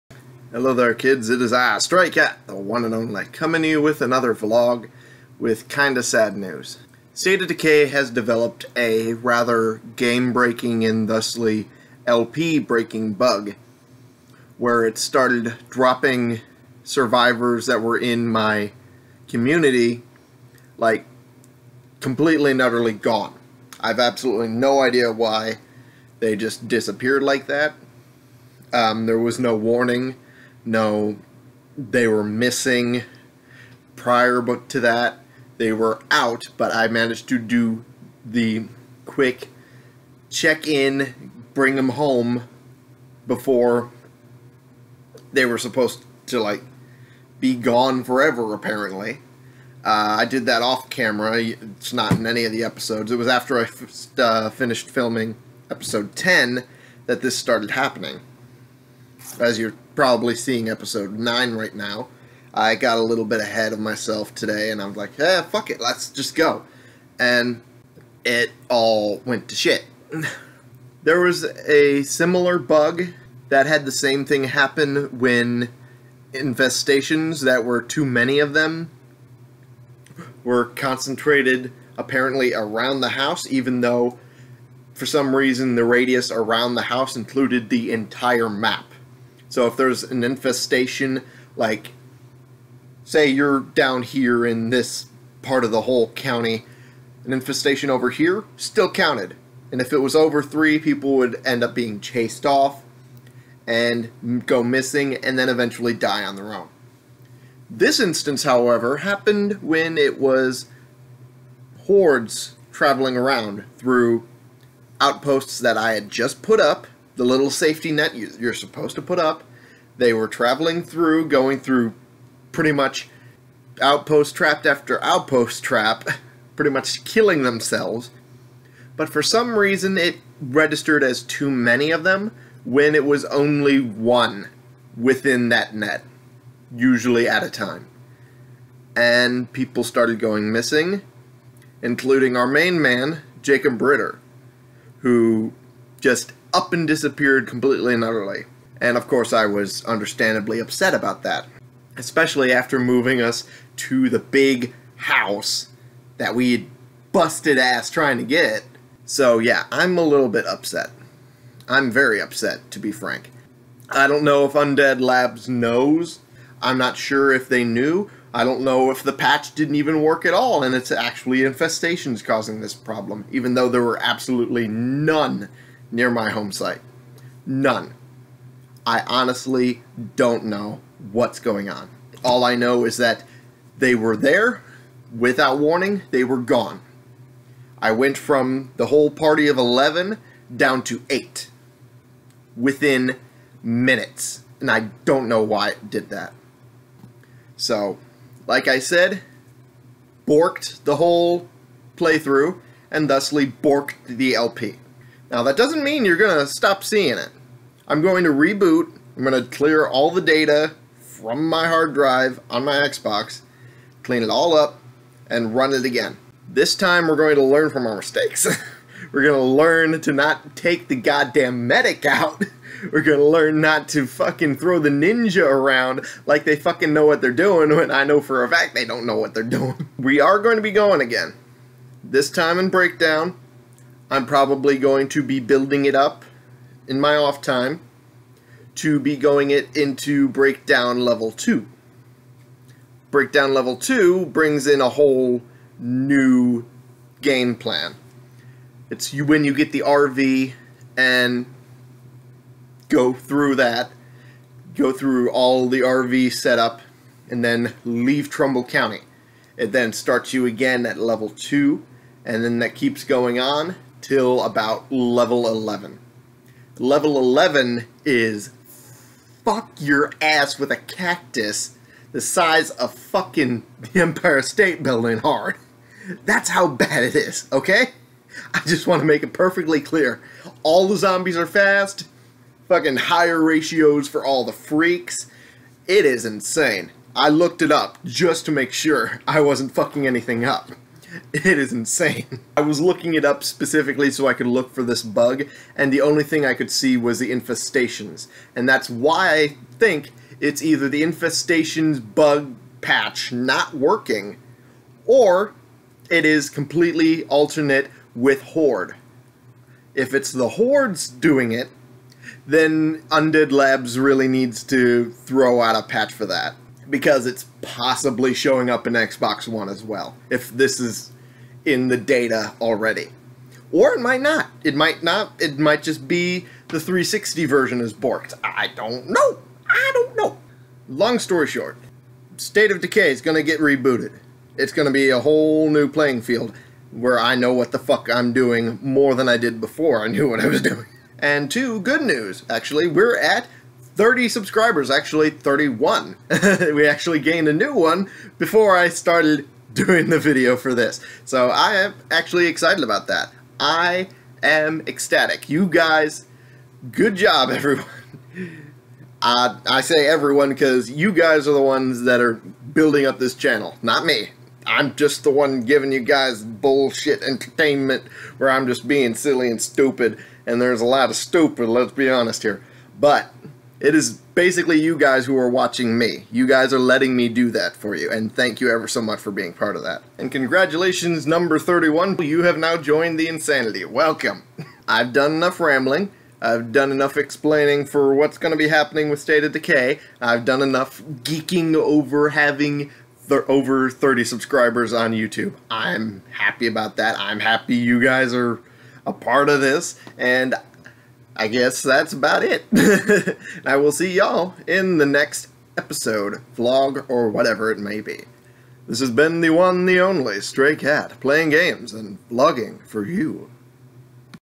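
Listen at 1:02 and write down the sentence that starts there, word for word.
I got a little bit ahead of myself today and I'm like, yeah, fuck it, let's just go.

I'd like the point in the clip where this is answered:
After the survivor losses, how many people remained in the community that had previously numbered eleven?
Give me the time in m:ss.
3:11.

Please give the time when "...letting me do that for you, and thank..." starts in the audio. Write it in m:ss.
6:16.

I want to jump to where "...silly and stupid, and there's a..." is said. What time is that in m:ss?
6:09.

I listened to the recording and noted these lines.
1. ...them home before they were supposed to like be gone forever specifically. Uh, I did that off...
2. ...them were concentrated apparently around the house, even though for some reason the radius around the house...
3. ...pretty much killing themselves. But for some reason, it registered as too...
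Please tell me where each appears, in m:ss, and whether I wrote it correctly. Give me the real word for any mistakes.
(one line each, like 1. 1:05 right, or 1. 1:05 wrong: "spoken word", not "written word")
1. 0:41 wrong: "apparently", not "specifically"
2. 1:18 right
3. 2:06 right.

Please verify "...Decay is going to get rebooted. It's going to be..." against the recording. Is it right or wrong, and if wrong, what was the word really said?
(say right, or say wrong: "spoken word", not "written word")
right.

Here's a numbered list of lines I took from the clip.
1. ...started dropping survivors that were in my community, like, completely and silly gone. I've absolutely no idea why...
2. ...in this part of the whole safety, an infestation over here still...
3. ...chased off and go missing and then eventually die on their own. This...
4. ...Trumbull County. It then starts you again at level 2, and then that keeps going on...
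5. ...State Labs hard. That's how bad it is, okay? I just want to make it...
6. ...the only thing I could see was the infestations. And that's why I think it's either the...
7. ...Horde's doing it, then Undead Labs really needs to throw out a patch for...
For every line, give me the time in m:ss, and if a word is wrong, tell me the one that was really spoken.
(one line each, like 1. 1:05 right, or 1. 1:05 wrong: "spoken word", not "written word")
1. 0:14 wrong: "utterly", not "silly"
2. 1:34 wrong: "county", not "safety"
3. 1:41 right
4. 4:18 right
5. 4:34 wrong: "Building", not "Labs"
6. 4:55 right
7. 5:10 right.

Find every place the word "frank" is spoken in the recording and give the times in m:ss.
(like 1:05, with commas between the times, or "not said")
2:42.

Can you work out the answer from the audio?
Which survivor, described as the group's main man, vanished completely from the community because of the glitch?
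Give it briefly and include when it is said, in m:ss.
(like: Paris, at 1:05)
Jacob Britter, at 2:23.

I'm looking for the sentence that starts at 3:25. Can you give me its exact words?
Now that doesn't mean you're going to stop seeing it.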